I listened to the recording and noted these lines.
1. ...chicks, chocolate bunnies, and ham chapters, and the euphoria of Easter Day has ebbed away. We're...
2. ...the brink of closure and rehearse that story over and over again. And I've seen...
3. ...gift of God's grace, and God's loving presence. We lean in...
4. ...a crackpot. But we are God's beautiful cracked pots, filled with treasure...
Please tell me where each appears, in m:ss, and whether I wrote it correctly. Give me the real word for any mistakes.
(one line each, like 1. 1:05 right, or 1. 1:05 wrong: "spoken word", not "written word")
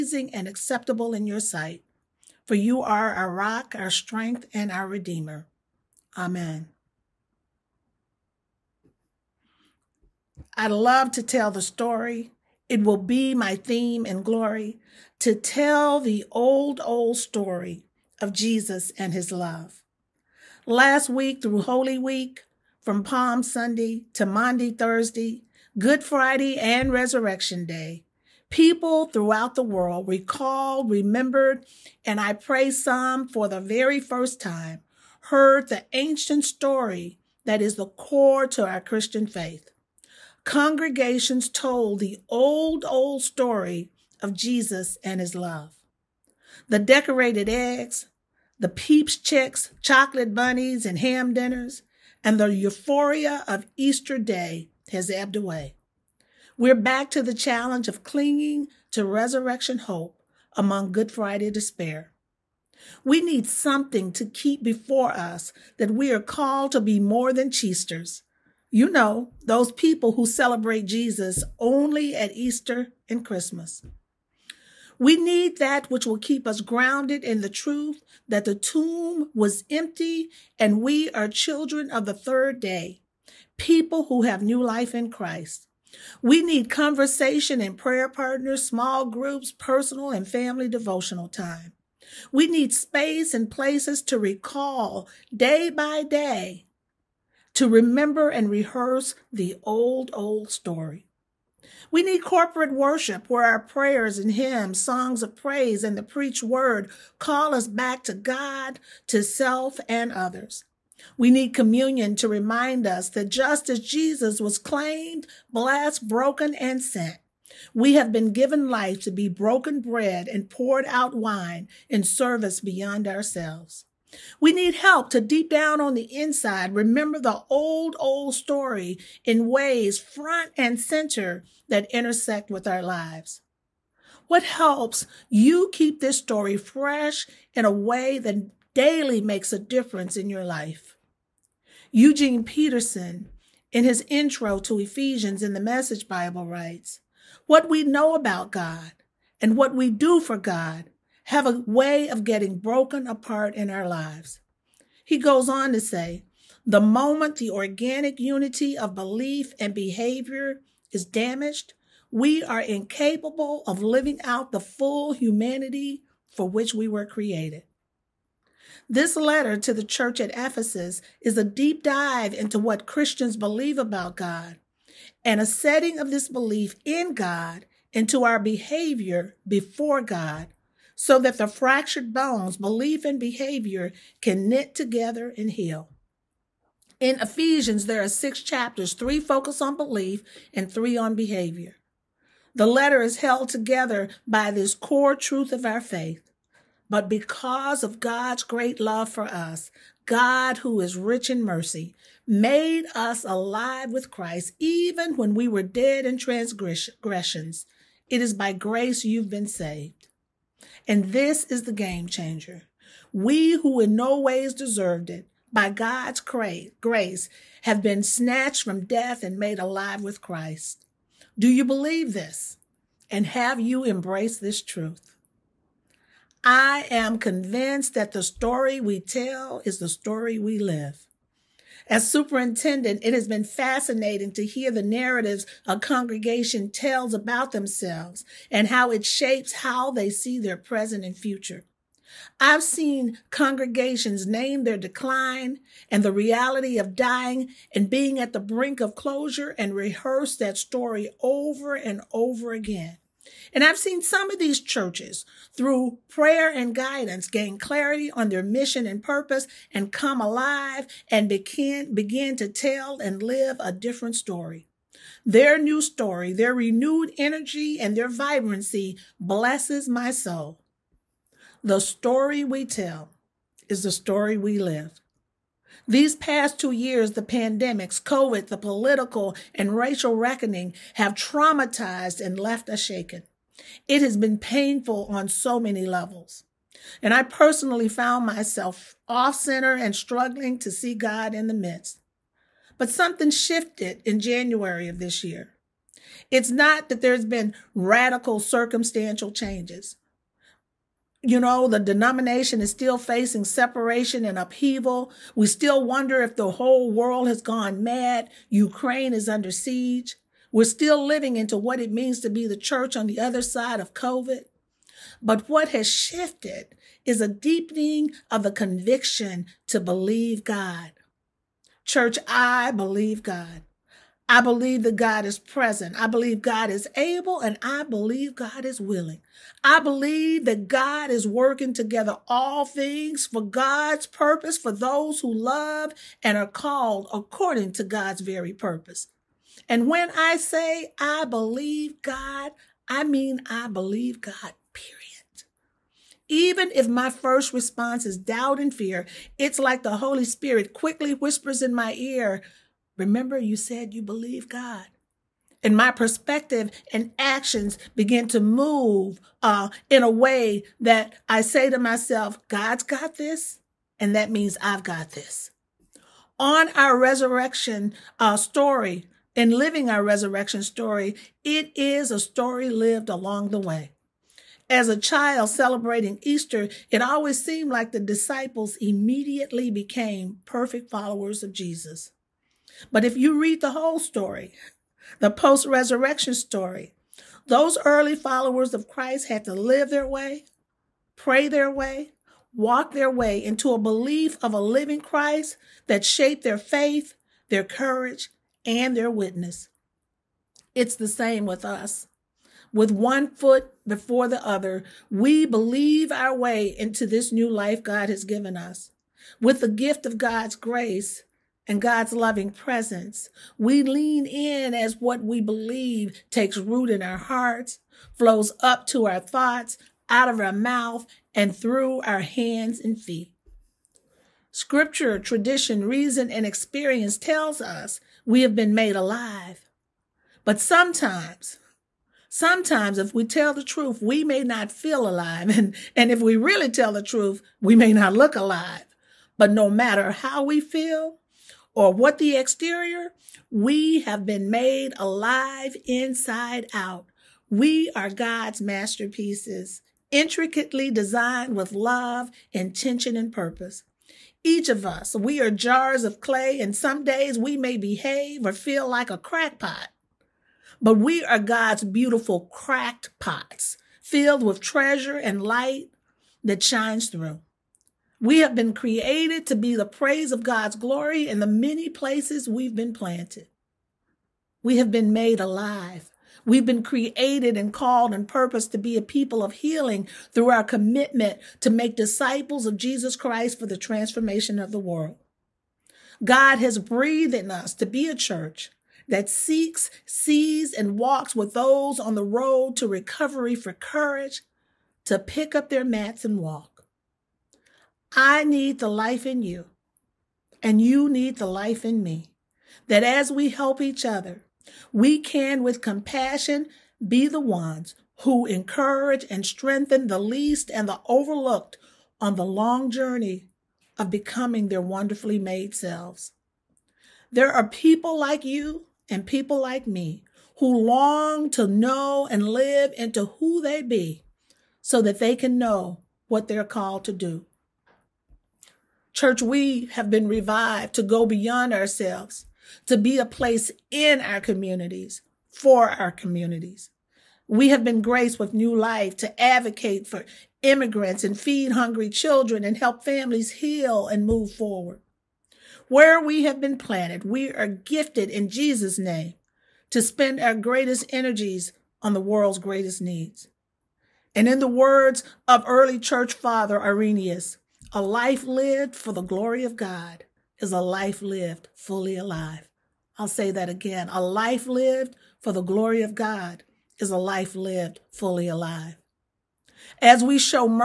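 1. 0:49 wrong: "dinners", not "chapters"
2. 4:08 right
3. 6:49 right
4. 7:39 right.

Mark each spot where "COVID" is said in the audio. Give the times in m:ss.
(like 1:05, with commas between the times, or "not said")
4:38, 5:13.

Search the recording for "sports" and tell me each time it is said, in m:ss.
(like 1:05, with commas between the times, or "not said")
not said.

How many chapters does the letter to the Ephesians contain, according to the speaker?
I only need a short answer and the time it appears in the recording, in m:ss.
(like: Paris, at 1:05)
6, at 3:08.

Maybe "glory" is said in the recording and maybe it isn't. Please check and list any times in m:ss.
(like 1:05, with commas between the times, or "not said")
0:14, 7:50, 9:19, 9:25.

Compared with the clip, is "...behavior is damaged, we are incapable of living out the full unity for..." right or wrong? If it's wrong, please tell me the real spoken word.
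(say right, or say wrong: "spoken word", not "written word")
wrong: "humanity", not "unity".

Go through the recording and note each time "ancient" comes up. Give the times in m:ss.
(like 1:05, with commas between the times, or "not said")
0:35.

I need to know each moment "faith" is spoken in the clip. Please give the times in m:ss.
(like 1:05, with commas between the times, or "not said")
0:39, 3:15, 6:36.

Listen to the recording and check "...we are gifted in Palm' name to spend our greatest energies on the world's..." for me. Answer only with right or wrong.
wrong.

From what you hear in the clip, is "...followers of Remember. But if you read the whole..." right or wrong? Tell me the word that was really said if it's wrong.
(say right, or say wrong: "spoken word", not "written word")
wrong: "Jesus", not "Remember".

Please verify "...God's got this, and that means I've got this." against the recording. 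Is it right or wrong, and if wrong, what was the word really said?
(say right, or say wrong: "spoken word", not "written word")
right.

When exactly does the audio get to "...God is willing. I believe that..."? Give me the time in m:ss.
5:28.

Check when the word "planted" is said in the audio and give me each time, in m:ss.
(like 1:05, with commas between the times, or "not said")
7:52, 9:06.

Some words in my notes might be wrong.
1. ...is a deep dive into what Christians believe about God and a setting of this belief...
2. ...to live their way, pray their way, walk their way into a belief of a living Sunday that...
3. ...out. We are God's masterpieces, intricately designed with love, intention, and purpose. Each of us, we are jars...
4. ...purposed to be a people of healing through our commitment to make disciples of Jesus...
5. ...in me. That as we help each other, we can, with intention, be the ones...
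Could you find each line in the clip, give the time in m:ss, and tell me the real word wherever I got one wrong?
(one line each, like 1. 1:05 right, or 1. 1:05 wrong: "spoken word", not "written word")
1. 2:51 right
2. 6:29 wrong: "Christ", not "Sunday"
3. 7:26 right
4. 7:58 right
5. 8:21 wrong: "compassion", not "intention".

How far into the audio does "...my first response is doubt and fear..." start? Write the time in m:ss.
5:46.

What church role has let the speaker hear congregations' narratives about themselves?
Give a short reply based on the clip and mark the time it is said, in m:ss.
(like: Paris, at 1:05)
Superintendent, at 3:52.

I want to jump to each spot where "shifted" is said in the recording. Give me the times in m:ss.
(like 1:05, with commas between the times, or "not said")
4:53, 5:15.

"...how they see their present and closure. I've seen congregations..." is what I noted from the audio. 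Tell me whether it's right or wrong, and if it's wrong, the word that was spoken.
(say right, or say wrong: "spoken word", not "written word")
wrong: "future", not "closure".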